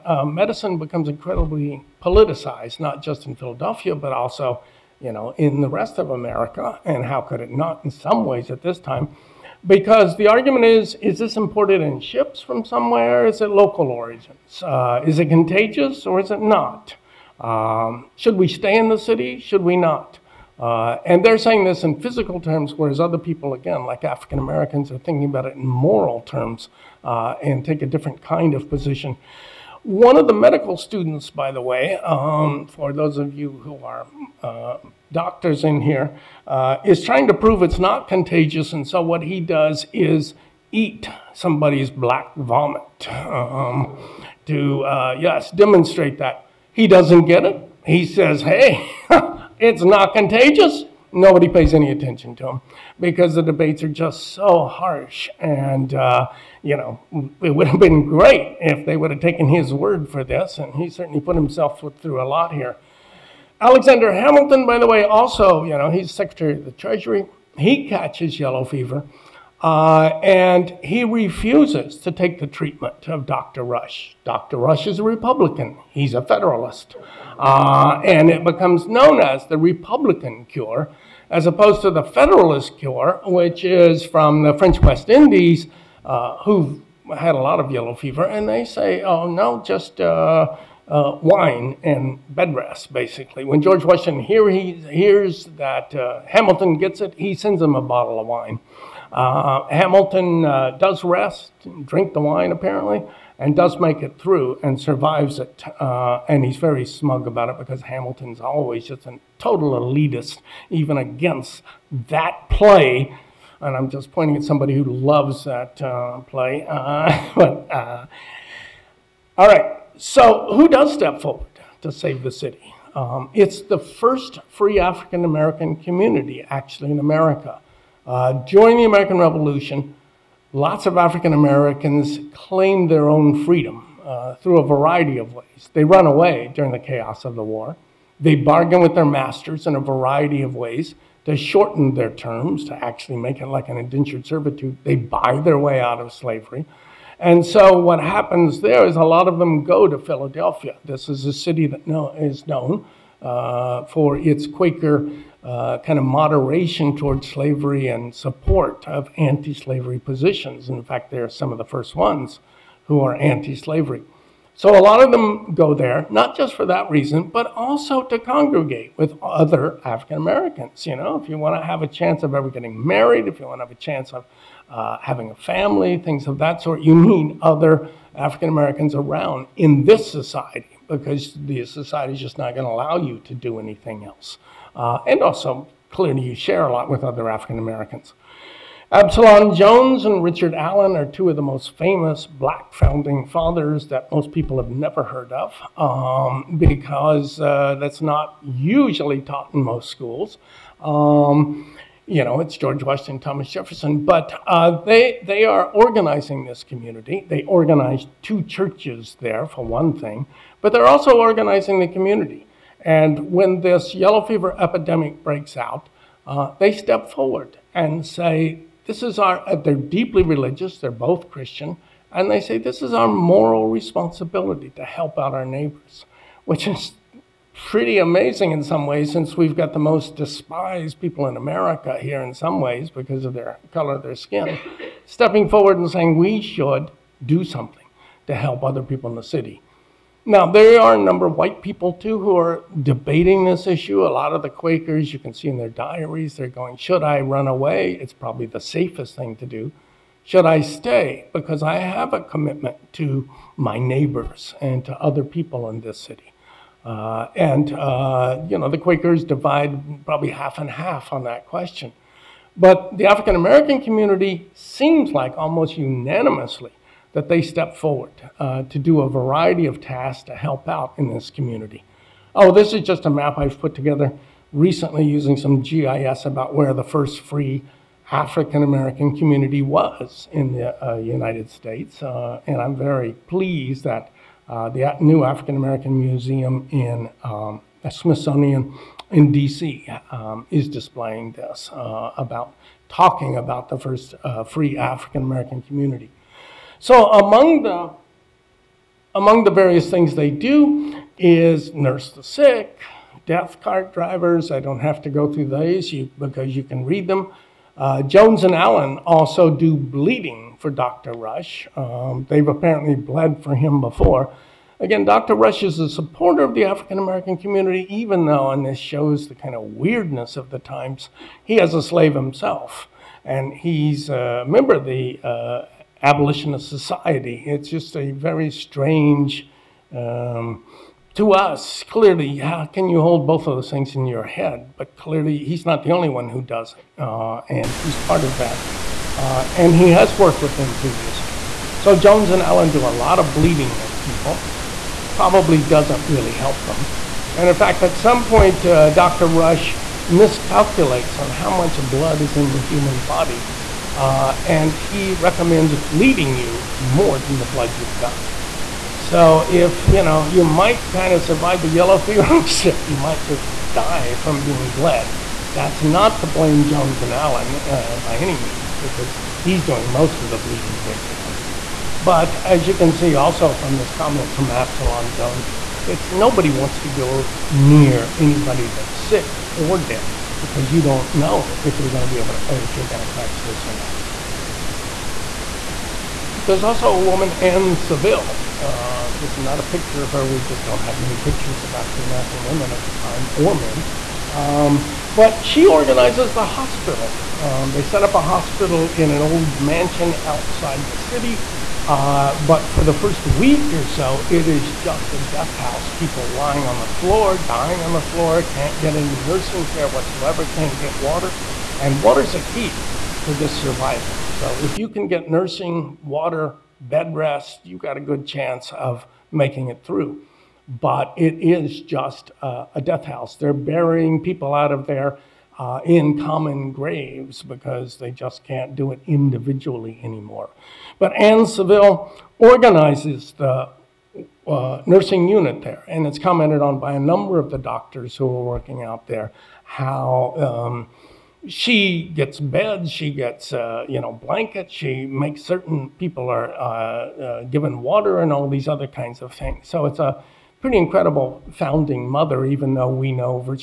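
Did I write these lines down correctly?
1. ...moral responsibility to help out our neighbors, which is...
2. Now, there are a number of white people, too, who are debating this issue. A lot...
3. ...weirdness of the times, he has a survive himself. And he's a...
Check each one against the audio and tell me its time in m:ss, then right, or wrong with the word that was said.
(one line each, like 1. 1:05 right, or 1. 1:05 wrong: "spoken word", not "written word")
1. 3:43 right
2. 4:00 right
3. 5:19 wrong: "slave", not "survive".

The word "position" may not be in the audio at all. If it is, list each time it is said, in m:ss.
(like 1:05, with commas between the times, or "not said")
0:28, 2:39.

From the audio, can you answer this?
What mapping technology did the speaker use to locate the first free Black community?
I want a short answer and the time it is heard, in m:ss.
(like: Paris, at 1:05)
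GIS, at 4:35.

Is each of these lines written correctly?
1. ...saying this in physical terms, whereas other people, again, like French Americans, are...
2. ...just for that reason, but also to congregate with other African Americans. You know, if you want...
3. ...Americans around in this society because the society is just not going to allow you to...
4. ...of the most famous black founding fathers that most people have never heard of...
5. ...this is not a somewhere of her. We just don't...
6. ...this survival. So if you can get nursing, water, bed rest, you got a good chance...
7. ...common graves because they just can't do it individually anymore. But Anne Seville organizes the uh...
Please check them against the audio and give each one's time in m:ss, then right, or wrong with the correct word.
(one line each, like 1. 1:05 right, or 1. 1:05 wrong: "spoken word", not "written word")
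1. 0:21 wrong: "African", not "French"
2. 2:46 right
3. 2:58 right
4. 3:11 right
5. 6:29 wrong: "picture", not "somewhere"
6. 6:53 right
7. 7:06 right.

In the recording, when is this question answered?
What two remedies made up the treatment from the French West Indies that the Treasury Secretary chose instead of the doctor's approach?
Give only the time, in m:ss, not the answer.
1:31.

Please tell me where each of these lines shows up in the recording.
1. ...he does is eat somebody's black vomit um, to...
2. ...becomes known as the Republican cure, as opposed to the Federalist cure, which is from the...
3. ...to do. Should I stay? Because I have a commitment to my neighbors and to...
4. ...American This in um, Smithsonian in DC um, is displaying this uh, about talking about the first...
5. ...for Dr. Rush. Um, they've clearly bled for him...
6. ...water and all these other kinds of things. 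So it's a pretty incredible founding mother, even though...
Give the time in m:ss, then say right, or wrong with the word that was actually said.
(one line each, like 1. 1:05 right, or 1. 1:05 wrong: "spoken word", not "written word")
1. 0:39 right
2. 1:18 right
3. 4:09 right
4. 4:45 wrong: "Museum", not "This"
5. 5:10 wrong: "apparently", not "clearly"
6. 7:27 right.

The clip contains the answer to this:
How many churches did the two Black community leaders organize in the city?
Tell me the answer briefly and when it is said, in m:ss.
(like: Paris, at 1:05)
2, at 3:28.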